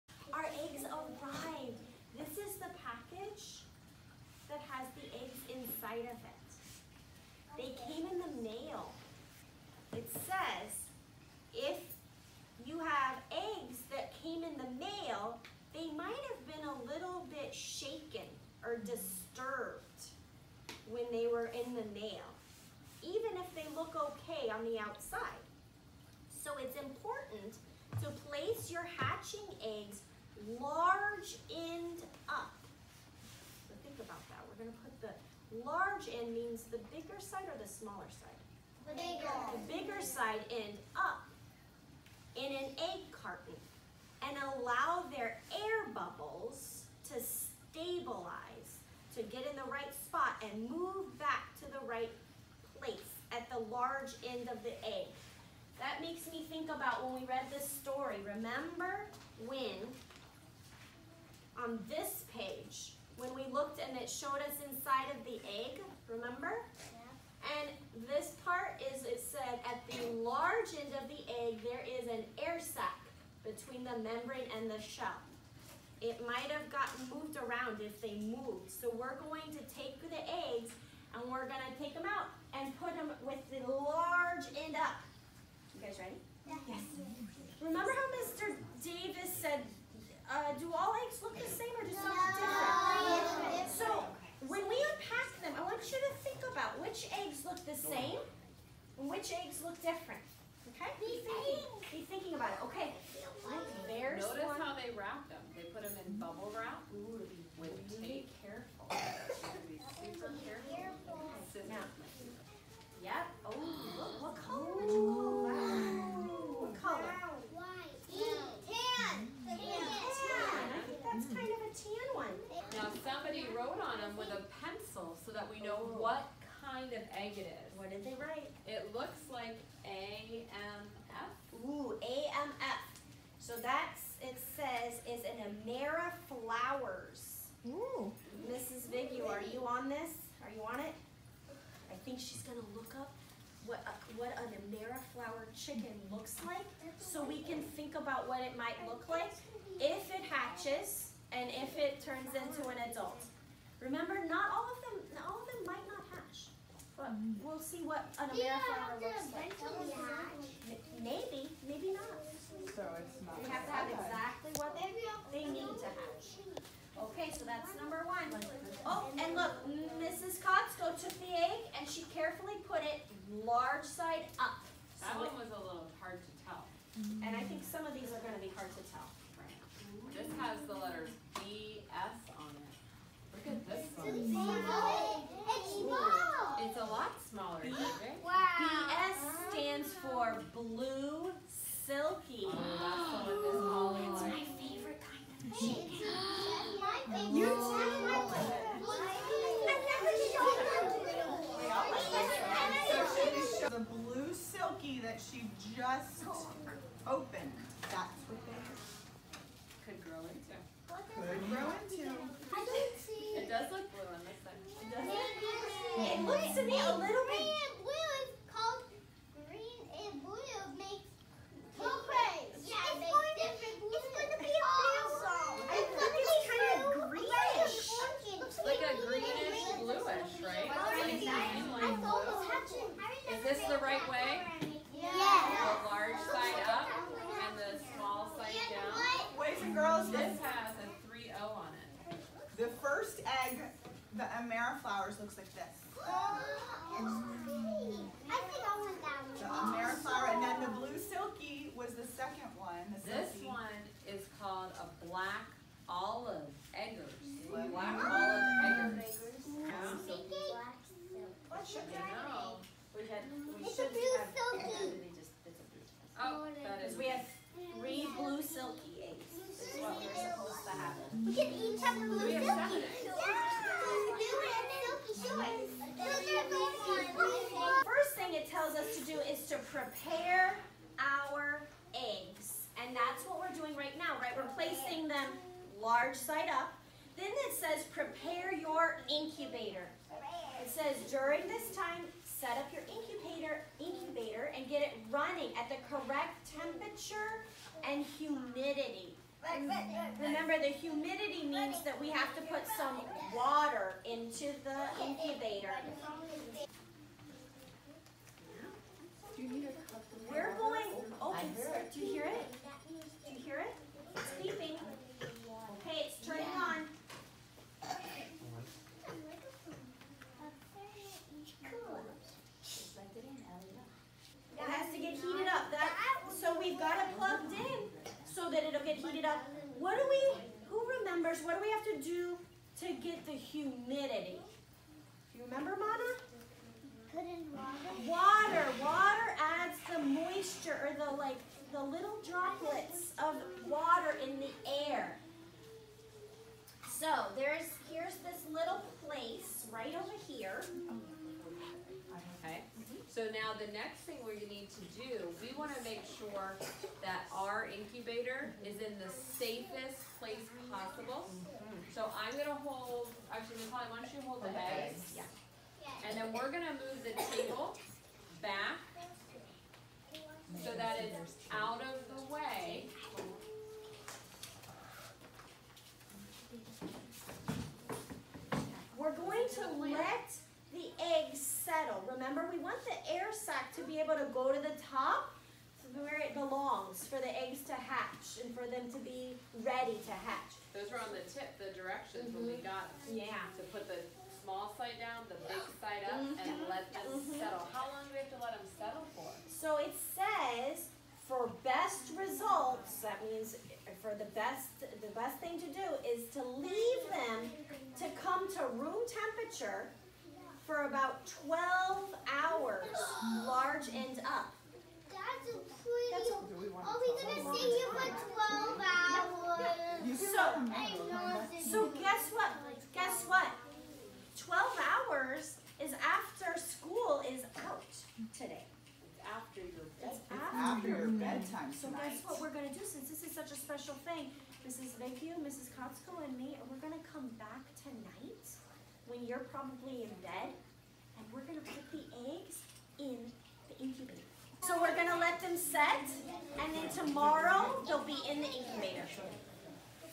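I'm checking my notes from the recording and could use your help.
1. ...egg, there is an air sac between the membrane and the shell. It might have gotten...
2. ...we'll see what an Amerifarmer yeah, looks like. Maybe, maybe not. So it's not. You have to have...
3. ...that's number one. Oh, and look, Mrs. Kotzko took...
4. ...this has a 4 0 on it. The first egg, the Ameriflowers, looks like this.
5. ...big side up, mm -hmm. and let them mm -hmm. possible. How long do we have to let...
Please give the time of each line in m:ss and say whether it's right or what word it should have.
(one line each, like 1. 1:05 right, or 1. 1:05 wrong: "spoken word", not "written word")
1. 1:11 right
2. 2:37 right
3. 2:47 right
4. 4:00 wrong: "3", not "4"
5. 6:35 wrong: "settle", not "possible".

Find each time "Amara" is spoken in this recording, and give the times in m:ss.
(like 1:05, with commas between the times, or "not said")
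2:15, 2:24.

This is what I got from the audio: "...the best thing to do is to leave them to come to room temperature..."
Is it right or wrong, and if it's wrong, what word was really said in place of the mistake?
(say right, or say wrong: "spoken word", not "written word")
right.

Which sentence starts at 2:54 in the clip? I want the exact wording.
So that one was a little hard to tell.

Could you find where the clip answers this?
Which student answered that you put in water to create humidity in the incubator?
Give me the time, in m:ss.
5:35.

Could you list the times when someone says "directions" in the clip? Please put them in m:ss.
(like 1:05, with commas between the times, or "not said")
6:31.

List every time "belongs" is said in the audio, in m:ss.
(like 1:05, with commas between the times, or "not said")
6:26.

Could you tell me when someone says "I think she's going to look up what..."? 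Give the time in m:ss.
2:21.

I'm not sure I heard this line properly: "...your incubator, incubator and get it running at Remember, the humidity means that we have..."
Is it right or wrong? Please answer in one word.
right.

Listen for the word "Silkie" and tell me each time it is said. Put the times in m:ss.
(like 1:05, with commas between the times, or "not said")
3:24, 4:11.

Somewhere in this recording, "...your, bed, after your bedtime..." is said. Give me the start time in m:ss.
7:09.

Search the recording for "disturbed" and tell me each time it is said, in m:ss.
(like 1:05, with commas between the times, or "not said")
0:18.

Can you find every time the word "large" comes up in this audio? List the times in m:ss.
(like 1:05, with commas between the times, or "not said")
0:30, 0:35, 0:53, 1:10, 1:23, 2:53, 4:45, 6:53.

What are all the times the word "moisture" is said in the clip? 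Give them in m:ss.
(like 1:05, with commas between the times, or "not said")
5:39.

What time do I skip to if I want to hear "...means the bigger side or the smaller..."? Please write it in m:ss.
0:36.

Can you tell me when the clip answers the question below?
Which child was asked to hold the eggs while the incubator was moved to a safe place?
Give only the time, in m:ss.
6:03.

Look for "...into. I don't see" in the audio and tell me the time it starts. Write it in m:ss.
3:31.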